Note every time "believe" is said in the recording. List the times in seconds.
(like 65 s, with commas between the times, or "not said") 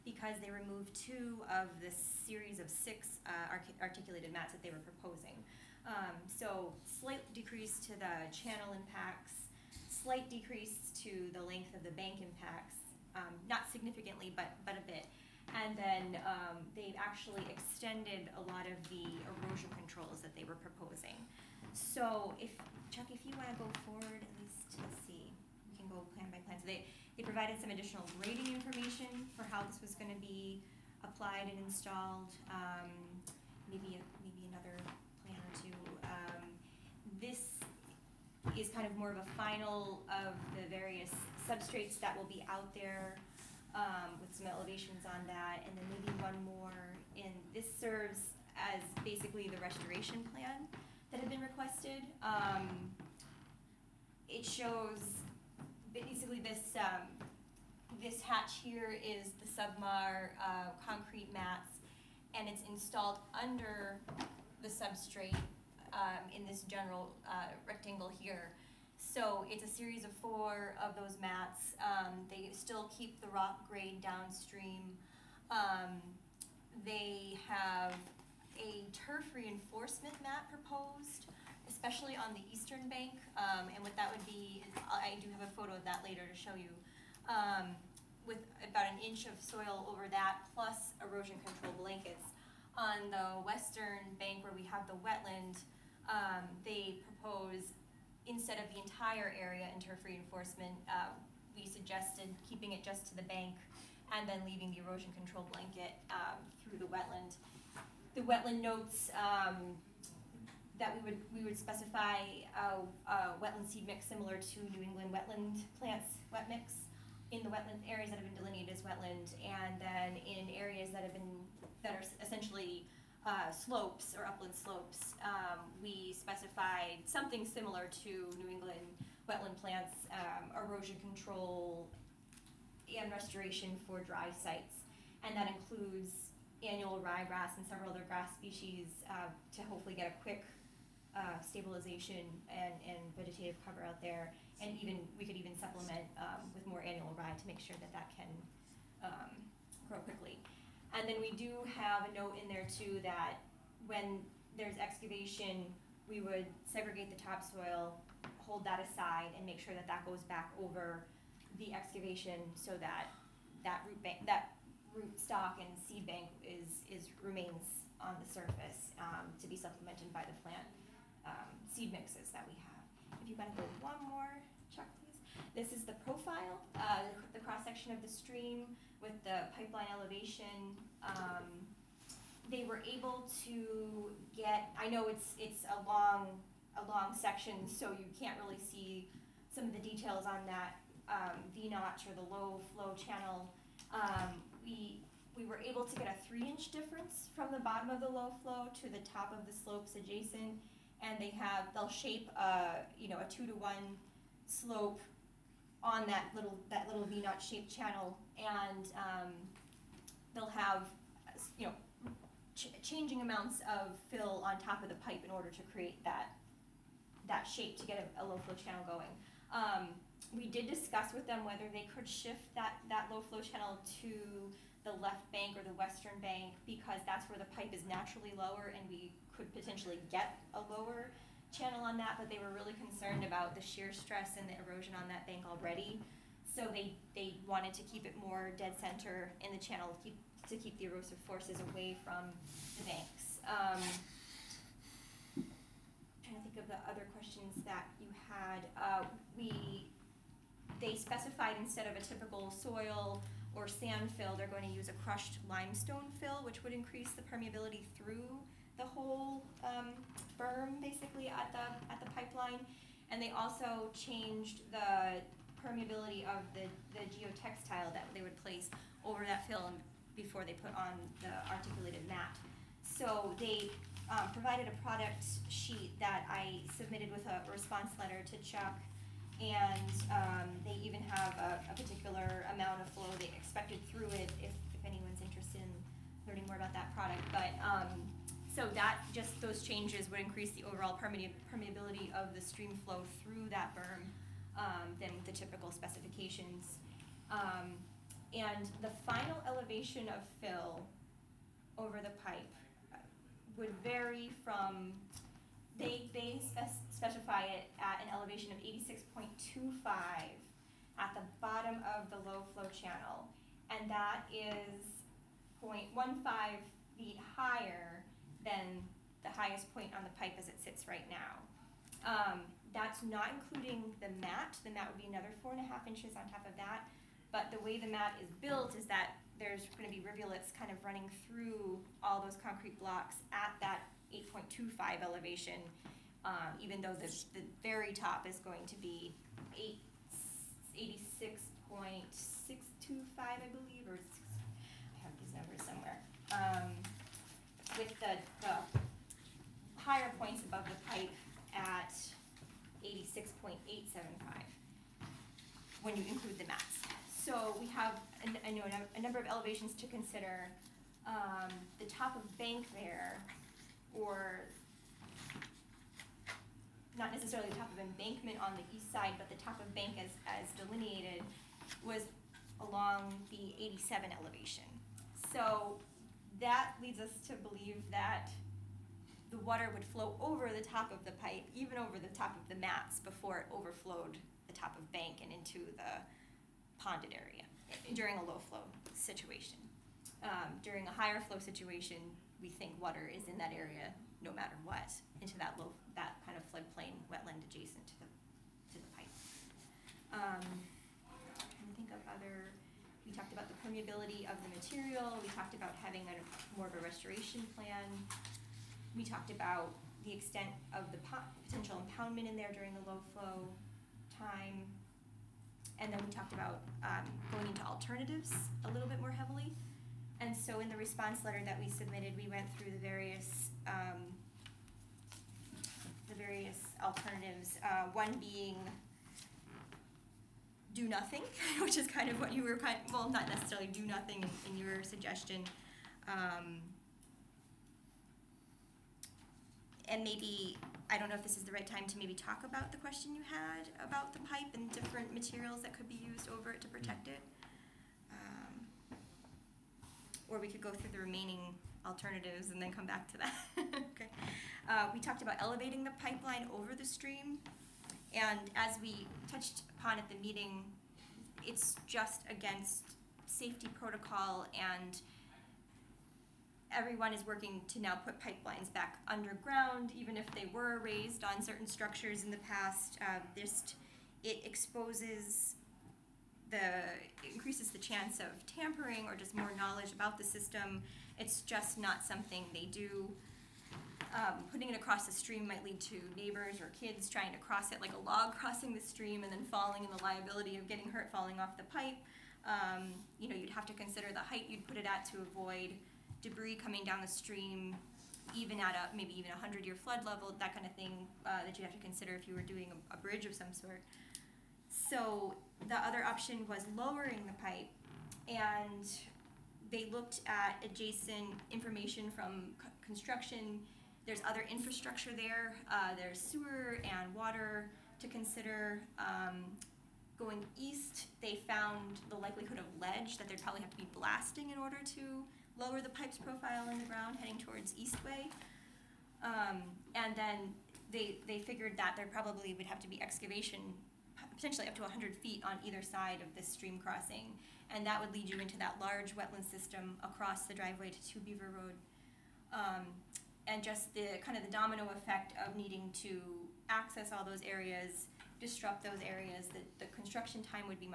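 343 s, 377 s.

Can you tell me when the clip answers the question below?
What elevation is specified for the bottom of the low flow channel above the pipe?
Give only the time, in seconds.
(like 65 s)
308 s.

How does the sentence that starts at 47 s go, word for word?
And this serves as basically the restoration plan that had been requested.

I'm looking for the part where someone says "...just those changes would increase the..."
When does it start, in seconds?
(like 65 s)
289 s.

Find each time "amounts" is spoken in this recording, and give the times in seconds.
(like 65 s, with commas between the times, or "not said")
213 s, 282 s.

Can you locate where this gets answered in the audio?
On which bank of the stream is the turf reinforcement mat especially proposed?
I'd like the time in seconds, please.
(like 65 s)
82 s.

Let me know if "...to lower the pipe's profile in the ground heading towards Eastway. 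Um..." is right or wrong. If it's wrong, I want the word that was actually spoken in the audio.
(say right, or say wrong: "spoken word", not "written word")
right.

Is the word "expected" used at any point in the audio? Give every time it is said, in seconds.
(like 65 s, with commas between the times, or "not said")
283 s.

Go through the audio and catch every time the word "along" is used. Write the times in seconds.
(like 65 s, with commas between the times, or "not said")
372 s.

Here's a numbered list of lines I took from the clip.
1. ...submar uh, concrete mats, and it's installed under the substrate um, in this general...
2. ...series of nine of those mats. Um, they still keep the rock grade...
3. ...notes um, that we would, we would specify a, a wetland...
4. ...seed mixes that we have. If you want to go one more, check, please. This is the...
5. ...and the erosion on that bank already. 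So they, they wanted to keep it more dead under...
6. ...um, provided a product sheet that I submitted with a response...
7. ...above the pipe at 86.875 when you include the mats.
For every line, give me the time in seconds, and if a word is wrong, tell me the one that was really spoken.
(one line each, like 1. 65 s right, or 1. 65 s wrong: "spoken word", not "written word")
1. 59 s right
2. 69 s wrong: "four", not "nine"
3. 108 s right
4. 171 s right
5. 234 s wrong: "center", not "under"
6. 274 s right
7. 350 s right.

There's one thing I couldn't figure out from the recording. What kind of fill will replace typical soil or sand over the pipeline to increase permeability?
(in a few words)
crushed limestone.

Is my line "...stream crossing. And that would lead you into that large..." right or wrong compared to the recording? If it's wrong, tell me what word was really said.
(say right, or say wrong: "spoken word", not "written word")
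right.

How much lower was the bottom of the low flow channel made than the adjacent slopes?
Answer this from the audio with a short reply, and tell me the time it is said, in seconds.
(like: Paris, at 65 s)
3 inches, at 196 s.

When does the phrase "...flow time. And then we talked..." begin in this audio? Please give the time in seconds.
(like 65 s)
413 s.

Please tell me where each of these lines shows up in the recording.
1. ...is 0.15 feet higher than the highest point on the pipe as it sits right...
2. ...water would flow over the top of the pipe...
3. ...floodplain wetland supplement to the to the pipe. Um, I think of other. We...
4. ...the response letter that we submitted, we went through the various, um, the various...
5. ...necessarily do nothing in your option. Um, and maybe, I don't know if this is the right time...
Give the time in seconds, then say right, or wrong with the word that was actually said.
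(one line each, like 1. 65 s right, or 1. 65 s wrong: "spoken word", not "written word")
1. 314 s right
2. 379 s right
3. 396 s wrong: "adjacent", not "supplement"
4. 420 s right
5. 433 s wrong: "suggestion", not "option".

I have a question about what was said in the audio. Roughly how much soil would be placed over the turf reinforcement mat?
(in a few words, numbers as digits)
an inch.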